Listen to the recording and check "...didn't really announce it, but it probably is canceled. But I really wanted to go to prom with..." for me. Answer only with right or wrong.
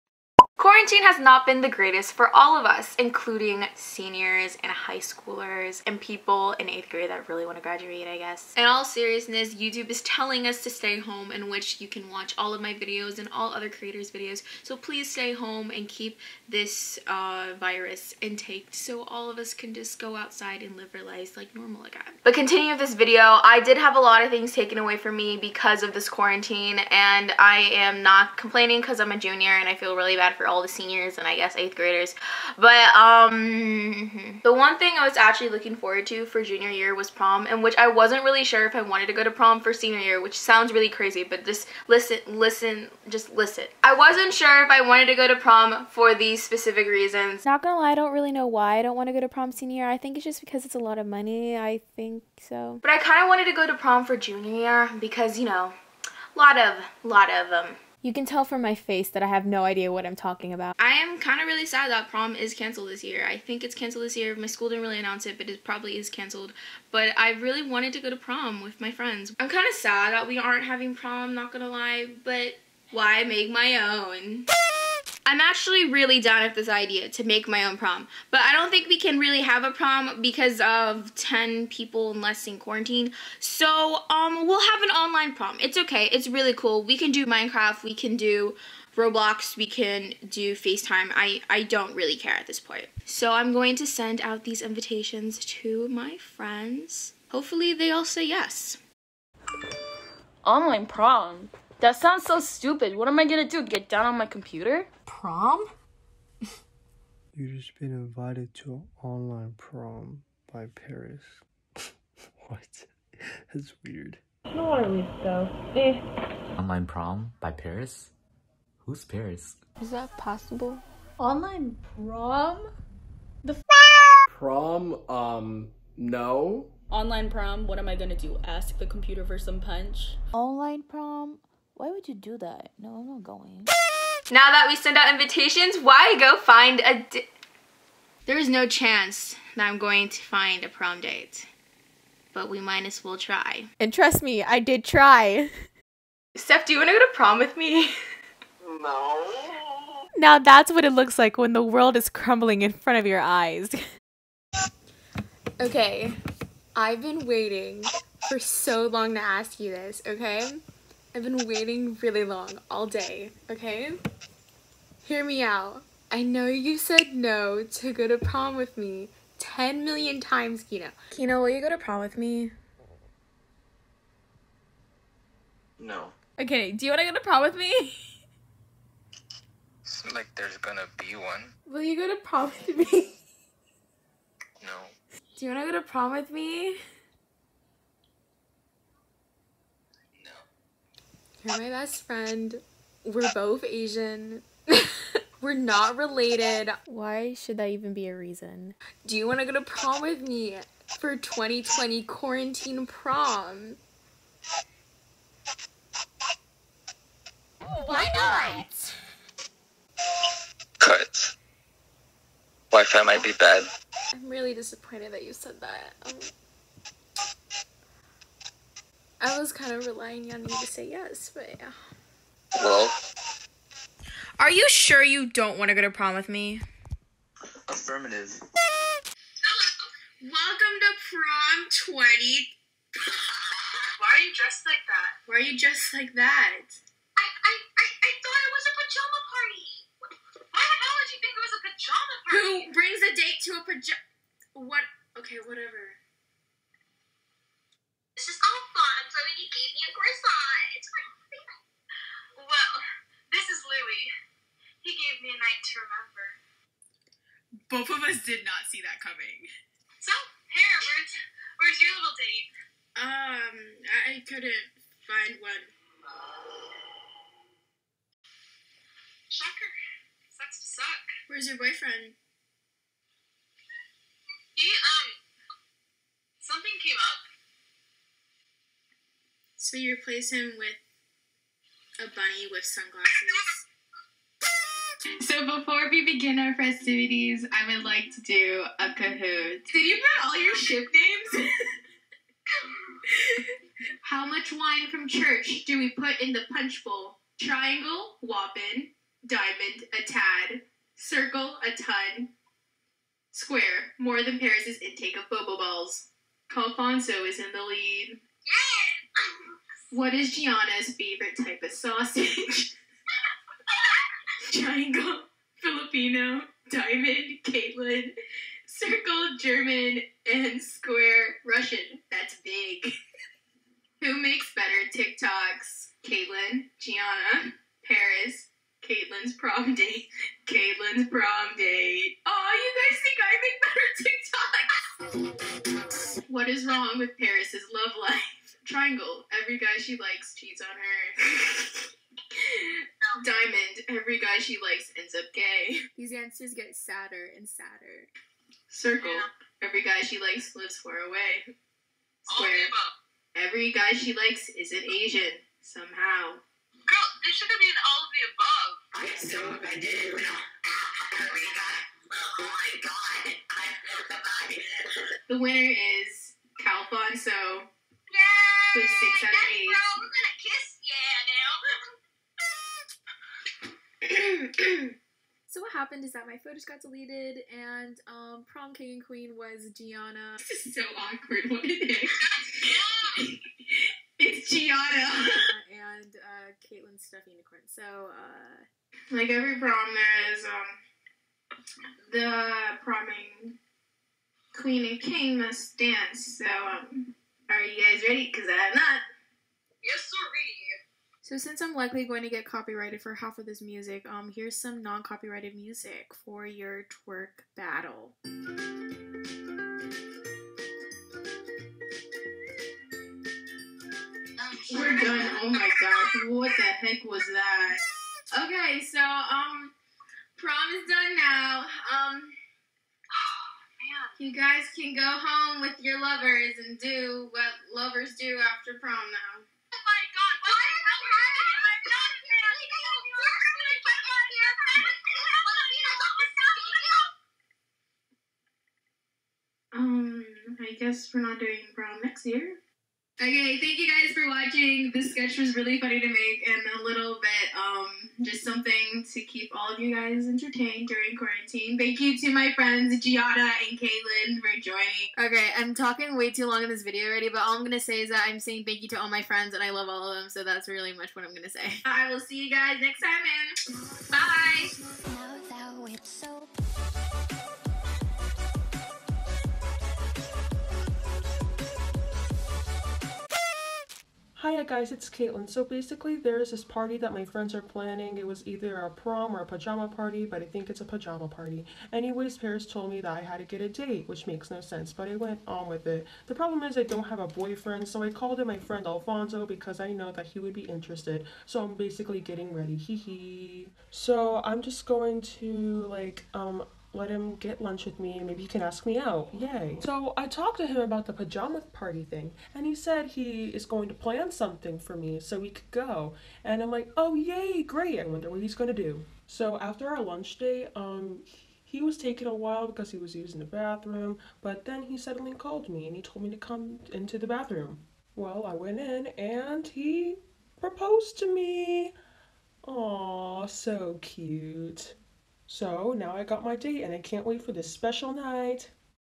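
right.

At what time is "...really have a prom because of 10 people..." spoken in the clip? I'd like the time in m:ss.
1:19.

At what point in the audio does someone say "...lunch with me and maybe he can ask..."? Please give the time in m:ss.
8:17.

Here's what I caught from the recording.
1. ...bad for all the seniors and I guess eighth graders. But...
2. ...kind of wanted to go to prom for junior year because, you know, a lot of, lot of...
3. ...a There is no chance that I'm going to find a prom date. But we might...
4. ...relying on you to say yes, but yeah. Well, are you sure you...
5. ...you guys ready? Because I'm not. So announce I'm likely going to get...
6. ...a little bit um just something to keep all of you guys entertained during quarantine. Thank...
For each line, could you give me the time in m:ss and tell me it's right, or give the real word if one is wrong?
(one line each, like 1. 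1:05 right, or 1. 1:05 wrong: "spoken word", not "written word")
1. 0:30 right
2. 0:52 right
3. 2:16 right
4. 3:39 right
5. 6:37 wrong: "since", not "announce"
6. 7:26 right.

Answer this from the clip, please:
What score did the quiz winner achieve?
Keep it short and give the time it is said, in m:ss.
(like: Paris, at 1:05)
6 out of 8, at 6:08.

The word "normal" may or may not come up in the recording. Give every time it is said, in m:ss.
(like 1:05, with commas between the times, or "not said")
0:21.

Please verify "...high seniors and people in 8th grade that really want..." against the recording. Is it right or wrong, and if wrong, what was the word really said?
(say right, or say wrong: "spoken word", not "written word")
wrong: "schoolers", not "seniors".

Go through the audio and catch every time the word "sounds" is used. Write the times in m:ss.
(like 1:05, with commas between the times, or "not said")
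0:40, 1:41.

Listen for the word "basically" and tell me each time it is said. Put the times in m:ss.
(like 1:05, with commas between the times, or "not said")
7:55, 8:11.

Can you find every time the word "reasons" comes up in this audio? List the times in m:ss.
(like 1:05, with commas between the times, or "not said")
0:46, 3:18.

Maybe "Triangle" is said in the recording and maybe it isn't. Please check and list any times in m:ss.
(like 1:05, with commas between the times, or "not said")
4:57, 5:14, 5:38.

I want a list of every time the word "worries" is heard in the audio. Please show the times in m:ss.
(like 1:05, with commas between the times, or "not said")
1:54.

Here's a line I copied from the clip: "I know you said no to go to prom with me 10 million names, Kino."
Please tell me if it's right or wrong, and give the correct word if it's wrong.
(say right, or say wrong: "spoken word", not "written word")
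wrong: "times", not "names".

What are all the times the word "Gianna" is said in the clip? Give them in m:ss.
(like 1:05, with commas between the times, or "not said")
5:10, 5:26, 6:19, 6:24, 7:32.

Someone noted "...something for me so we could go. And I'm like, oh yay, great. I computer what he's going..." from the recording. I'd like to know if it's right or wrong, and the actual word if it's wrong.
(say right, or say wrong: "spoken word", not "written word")
wrong: "wonder", not "computer".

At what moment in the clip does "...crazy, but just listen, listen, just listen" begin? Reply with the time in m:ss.
0:40.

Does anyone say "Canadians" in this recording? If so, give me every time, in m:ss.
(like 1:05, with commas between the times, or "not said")
not said.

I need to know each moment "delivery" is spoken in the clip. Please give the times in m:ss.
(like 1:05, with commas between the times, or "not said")
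not said.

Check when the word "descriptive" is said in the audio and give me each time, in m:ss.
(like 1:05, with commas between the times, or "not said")
not said.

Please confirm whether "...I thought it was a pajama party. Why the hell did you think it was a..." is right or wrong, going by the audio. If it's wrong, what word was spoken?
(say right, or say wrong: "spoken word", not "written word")
right.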